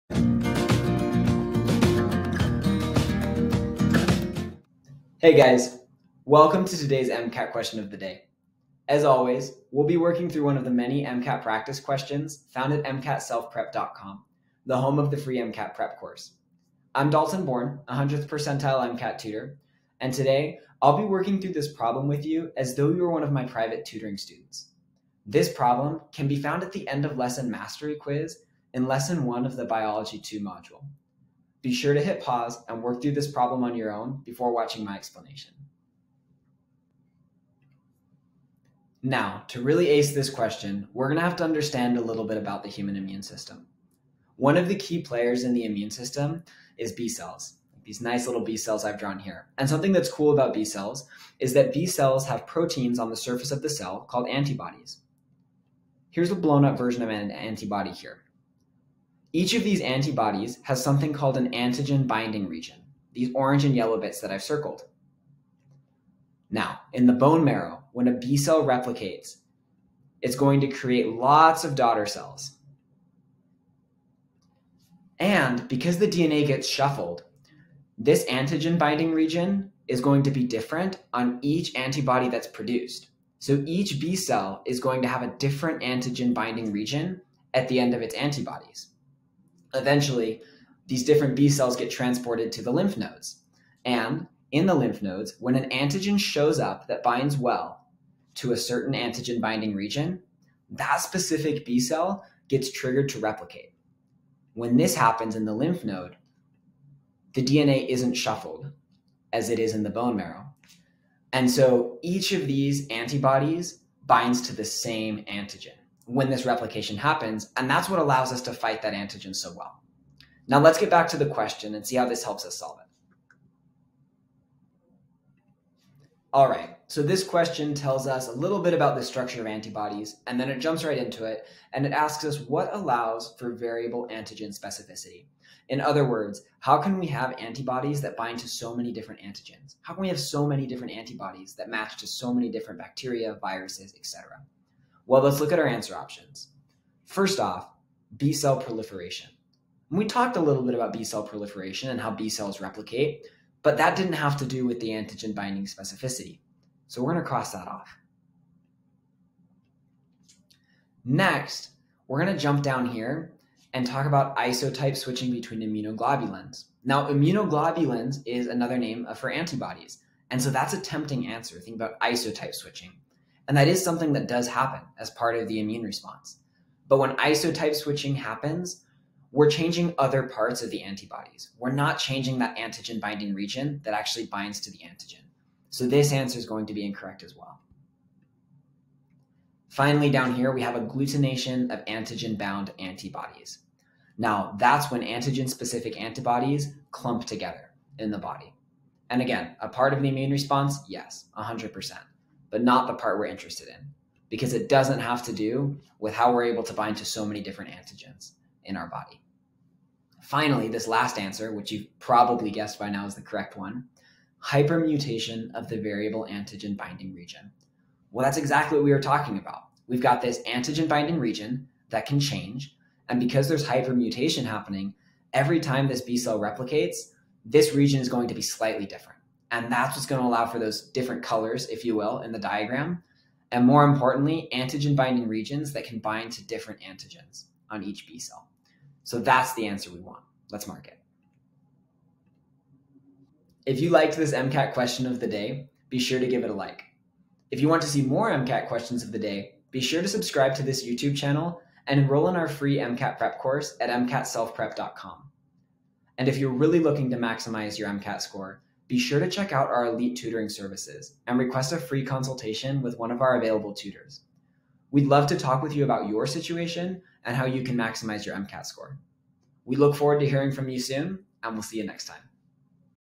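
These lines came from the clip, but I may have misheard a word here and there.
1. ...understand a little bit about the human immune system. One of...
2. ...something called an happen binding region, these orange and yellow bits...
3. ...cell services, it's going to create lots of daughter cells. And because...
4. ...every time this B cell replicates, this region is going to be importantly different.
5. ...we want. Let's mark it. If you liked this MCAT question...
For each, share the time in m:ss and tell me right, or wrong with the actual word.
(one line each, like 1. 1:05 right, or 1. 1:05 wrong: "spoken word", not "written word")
1. 0:41 right
2. 1:00 wrong: "antigen", not "happen"
3. 1:08 wrong: "replicates", not "services"
4. 3:45 wrong: "slightly", not "importantly"
5. 3:59 right.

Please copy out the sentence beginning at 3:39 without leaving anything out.
We've got this antigen binding region that can change.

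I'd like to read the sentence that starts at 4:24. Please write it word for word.
We'd love to talk with you about your situation and how you can maximize your MCAT score.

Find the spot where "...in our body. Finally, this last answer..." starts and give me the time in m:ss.
3:28.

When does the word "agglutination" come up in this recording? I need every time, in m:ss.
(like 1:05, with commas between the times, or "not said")
3:10.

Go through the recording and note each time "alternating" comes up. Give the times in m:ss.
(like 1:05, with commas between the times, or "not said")
not said.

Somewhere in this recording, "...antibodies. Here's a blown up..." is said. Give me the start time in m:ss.
0:54.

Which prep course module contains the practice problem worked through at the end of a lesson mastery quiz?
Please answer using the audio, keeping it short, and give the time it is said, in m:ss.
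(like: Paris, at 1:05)
Biology 2, at 0:29.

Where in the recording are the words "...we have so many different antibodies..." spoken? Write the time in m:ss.
2:20.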